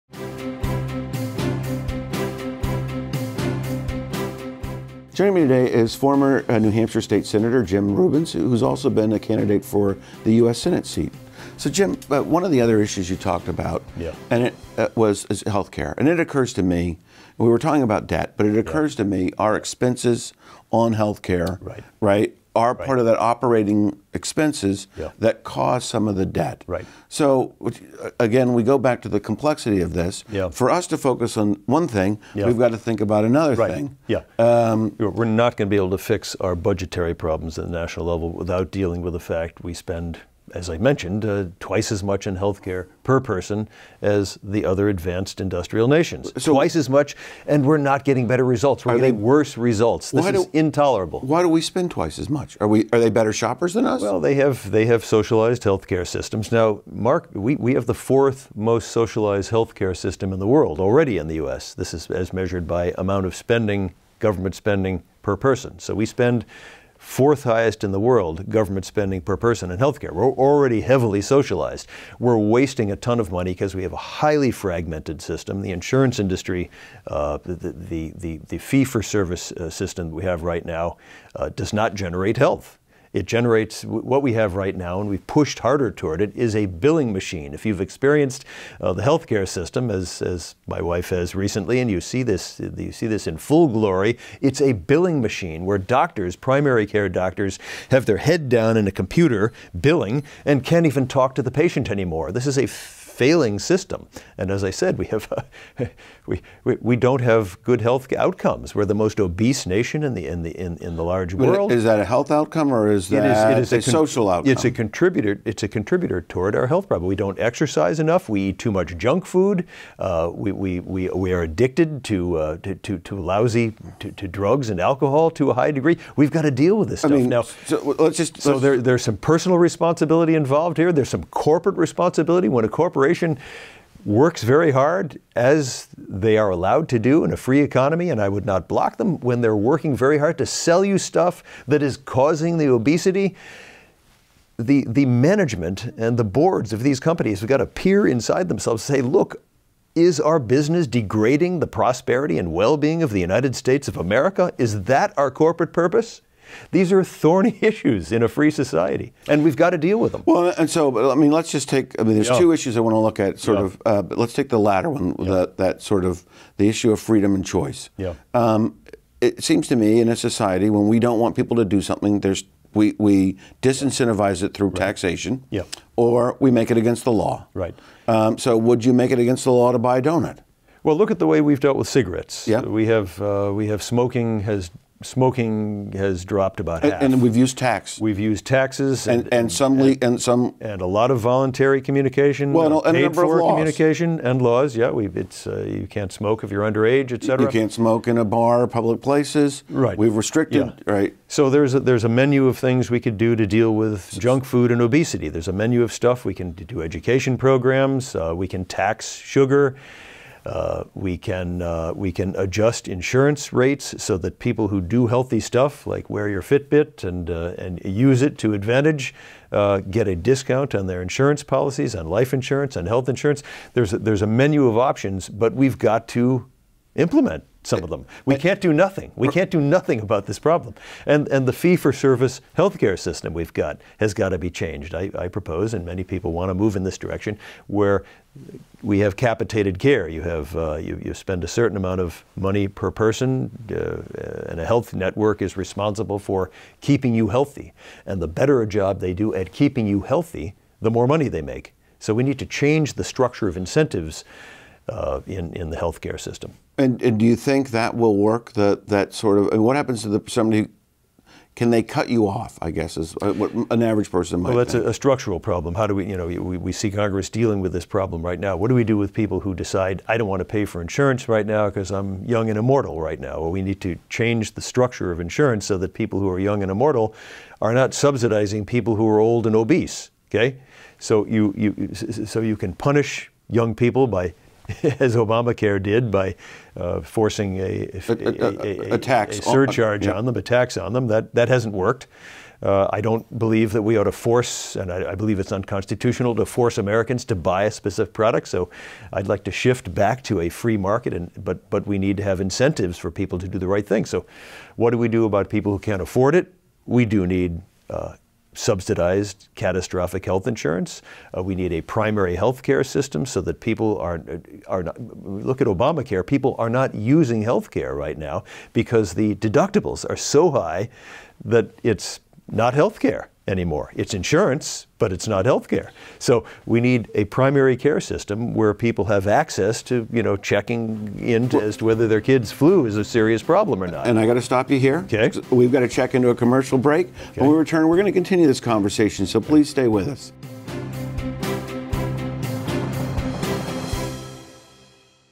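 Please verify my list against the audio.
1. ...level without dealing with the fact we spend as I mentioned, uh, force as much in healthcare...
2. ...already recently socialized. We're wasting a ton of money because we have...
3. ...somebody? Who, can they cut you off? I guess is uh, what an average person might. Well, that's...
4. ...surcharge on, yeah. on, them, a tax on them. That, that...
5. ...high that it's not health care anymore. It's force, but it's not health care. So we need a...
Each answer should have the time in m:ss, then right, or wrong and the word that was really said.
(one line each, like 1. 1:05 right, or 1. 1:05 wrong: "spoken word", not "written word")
1. 0:38 wrong: "twice", not "force"
2. 1:10 wrong: "heavily", not "recently"
3. 4:20 right
4. 4:49 right
5. 5:20 wrong: "insurance", not "force".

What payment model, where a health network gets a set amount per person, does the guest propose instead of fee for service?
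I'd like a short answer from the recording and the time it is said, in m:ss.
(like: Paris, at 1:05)
Capitated care, at 3:59.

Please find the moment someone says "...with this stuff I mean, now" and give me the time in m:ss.
2:06.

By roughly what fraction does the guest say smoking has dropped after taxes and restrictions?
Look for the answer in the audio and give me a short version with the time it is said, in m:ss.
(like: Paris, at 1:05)
About half, at 3:06.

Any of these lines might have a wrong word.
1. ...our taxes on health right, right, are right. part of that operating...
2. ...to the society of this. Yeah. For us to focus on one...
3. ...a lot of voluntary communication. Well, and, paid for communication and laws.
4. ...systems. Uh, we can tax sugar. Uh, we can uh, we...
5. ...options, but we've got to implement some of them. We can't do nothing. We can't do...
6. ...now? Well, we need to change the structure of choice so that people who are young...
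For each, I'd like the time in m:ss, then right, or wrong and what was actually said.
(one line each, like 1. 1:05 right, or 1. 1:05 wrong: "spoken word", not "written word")
1. 0:19 wrong: "expenses", not "taxes"
2. 0:29 wrong: "complexity", not "society"
3. 3:10 right
4. 3:27 wrong: "programs", not "systems"
5. 3:44 right
6. 4:33 wrong: "insurance", not "choice".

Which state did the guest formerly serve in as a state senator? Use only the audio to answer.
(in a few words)
New Hampshire.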